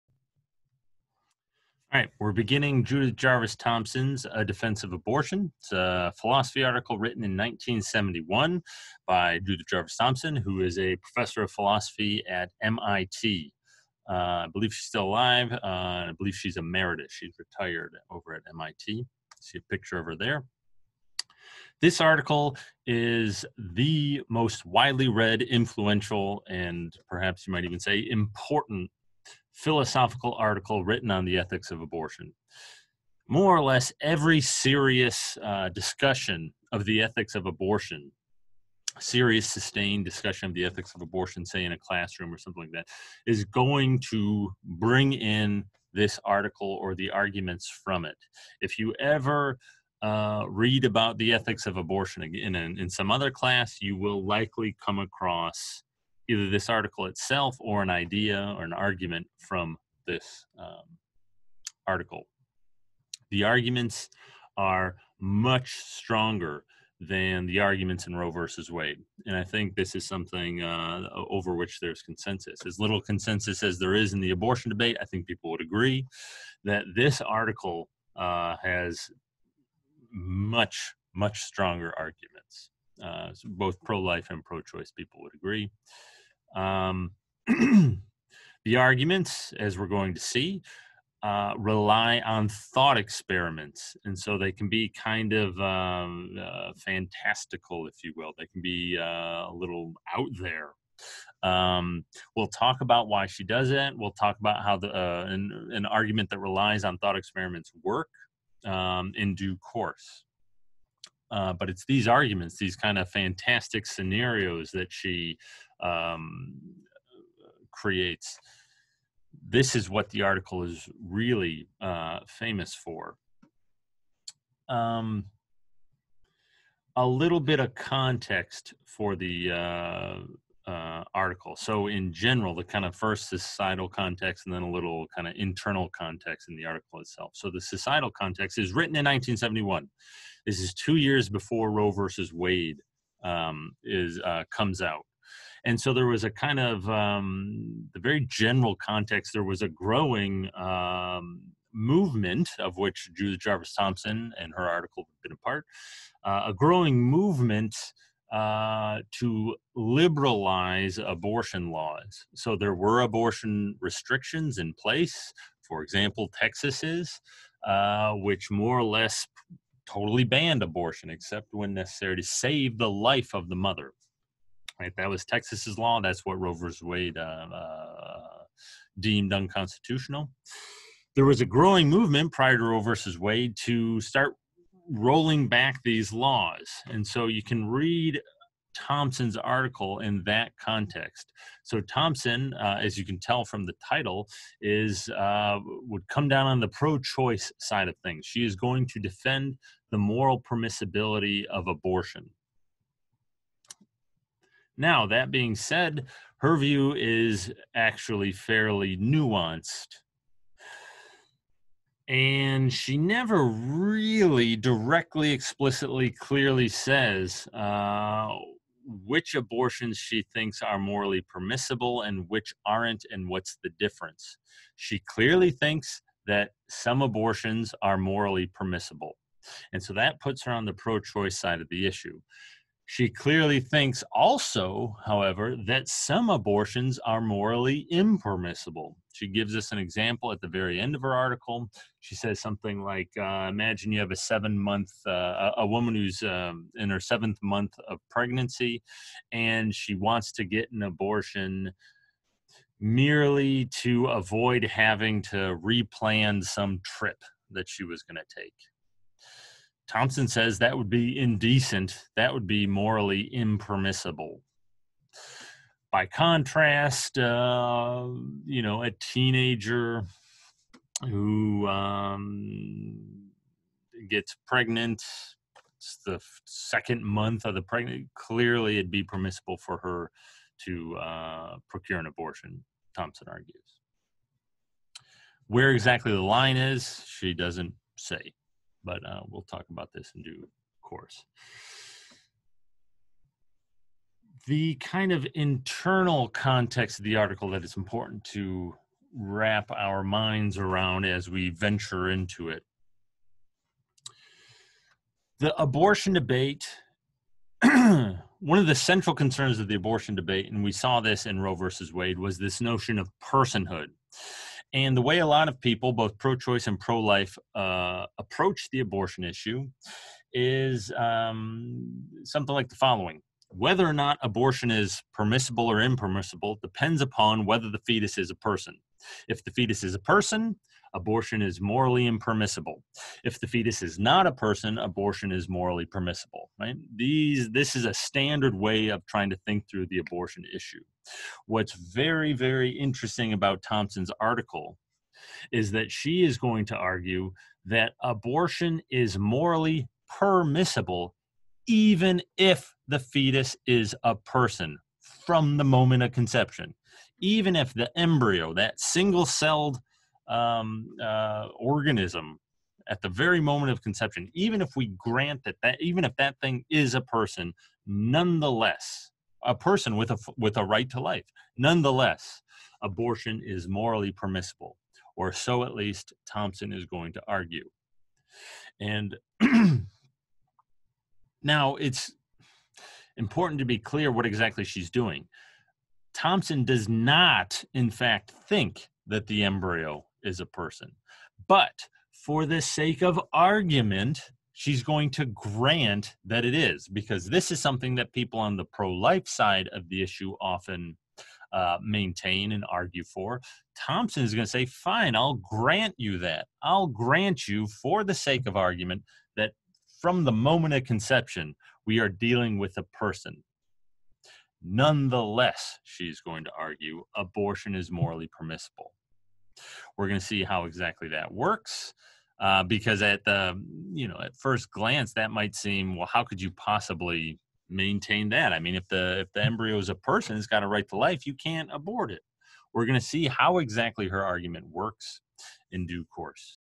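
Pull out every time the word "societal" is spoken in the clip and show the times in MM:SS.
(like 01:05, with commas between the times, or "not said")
02:13, 02:17.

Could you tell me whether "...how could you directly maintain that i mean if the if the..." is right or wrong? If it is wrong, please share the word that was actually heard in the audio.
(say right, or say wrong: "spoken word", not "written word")
wrong: "possibly", not "directly".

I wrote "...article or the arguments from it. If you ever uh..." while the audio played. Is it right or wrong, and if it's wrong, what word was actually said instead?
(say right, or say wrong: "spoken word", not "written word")
right.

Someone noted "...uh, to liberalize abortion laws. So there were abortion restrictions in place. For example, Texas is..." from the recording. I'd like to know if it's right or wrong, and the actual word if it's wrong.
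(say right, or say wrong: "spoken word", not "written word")
right.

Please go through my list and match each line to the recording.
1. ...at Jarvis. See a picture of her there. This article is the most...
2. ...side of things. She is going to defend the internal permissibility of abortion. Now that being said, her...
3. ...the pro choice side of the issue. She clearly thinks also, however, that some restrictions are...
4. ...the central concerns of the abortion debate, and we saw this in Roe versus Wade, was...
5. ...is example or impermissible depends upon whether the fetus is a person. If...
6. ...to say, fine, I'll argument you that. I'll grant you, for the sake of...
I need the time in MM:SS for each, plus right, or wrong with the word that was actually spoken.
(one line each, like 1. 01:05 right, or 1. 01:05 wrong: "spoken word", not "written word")
1. 00:18 wrong: "MIT", not "Jarvis"
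2. 03:17 wrong: "moral", not "internal"
3. 03:50 wrong: "abortions", not "restrictions"
4. 05:08 right
5. 05:24 wrong: "permissible", not "example"
6. 06:44 wrong: "grant", not "argument".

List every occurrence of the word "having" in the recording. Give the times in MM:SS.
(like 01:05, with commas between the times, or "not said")
04:14.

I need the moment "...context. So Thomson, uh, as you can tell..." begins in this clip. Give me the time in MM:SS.
03:10.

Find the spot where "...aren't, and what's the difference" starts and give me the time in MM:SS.
03:42.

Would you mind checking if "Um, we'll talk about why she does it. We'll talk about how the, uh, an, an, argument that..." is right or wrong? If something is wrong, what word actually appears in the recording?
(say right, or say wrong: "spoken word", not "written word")
right.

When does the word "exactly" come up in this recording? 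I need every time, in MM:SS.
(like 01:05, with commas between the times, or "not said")
04:45, 06:24, 07:00, 07:13.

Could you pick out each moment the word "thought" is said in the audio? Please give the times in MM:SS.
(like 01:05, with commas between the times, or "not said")
01:32, 01:46.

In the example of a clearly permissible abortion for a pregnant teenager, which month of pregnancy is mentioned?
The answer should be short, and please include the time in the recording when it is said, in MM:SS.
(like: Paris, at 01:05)
Second, at 04:36.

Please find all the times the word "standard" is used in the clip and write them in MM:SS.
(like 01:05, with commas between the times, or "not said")
05:37.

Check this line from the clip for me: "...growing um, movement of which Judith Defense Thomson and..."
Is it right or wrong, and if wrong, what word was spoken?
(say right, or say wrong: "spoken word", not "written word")
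wrong: "Jarvis", not "Defense".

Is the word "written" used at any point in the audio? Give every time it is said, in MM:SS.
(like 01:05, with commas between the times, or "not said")
00:06, 00:30, 02:18.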